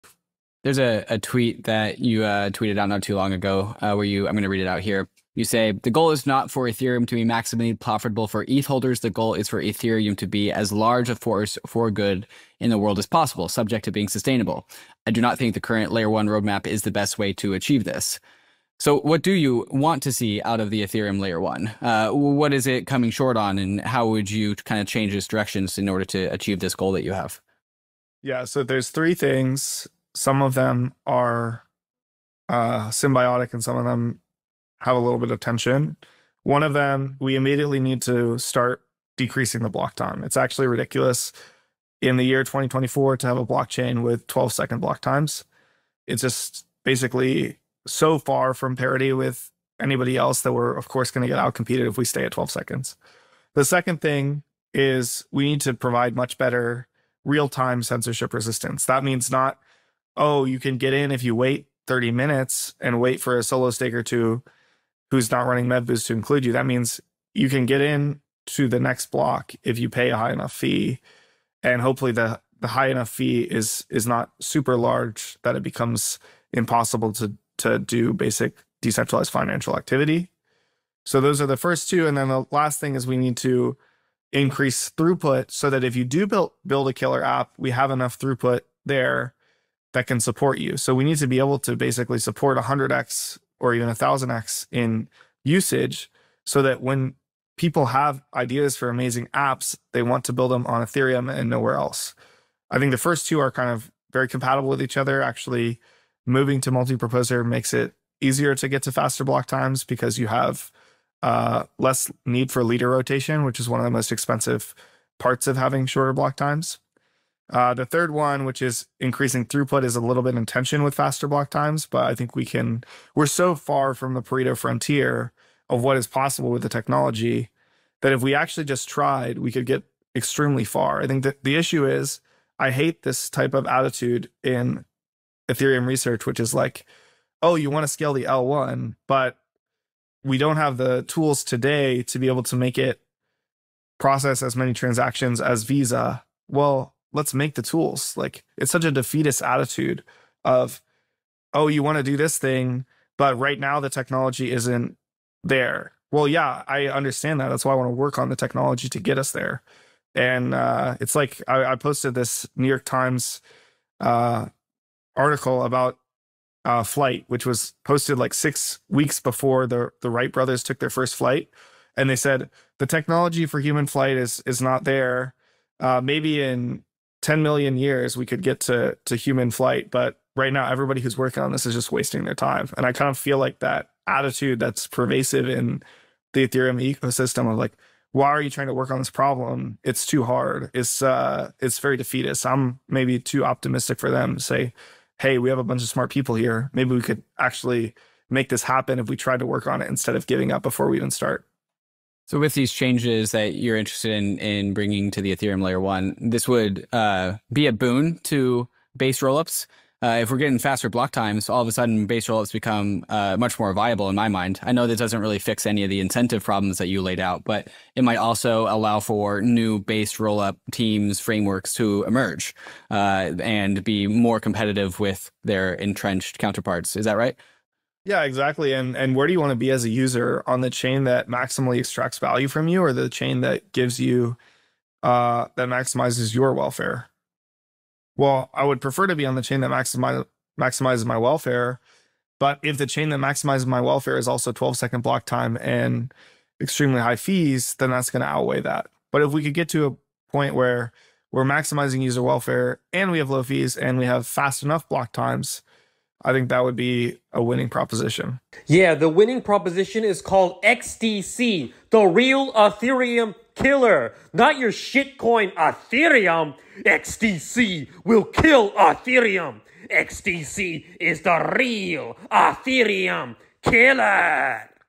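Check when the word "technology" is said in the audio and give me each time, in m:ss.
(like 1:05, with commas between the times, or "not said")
2:06, 2:33, 2:38, 2:52.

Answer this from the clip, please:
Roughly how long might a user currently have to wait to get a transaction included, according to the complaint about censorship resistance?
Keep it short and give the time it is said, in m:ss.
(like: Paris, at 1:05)
30 minutes, at 1:01.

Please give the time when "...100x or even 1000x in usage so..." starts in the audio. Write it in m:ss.
1:32.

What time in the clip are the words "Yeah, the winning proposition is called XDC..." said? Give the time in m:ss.
4:18.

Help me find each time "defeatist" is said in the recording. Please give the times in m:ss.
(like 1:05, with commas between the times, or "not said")
2:28, 3:11.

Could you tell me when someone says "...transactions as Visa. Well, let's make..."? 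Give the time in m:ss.
2:24.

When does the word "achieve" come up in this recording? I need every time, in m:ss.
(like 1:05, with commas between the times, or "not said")
0:17, 0:26.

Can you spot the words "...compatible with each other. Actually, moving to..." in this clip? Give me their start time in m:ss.
1:44.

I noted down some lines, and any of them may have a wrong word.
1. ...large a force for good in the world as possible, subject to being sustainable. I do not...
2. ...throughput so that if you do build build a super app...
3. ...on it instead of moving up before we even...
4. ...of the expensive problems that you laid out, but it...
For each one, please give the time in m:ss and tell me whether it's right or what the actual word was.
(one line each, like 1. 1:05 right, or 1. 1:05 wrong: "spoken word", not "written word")
1. 0:10 right
2. 1:24 wrong: "killer", not "super"
3. 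3:19 wrong: "giving", not "moving"
4. 3:35 wrong: "incentive", not "expensive".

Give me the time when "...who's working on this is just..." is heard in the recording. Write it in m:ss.
3:01.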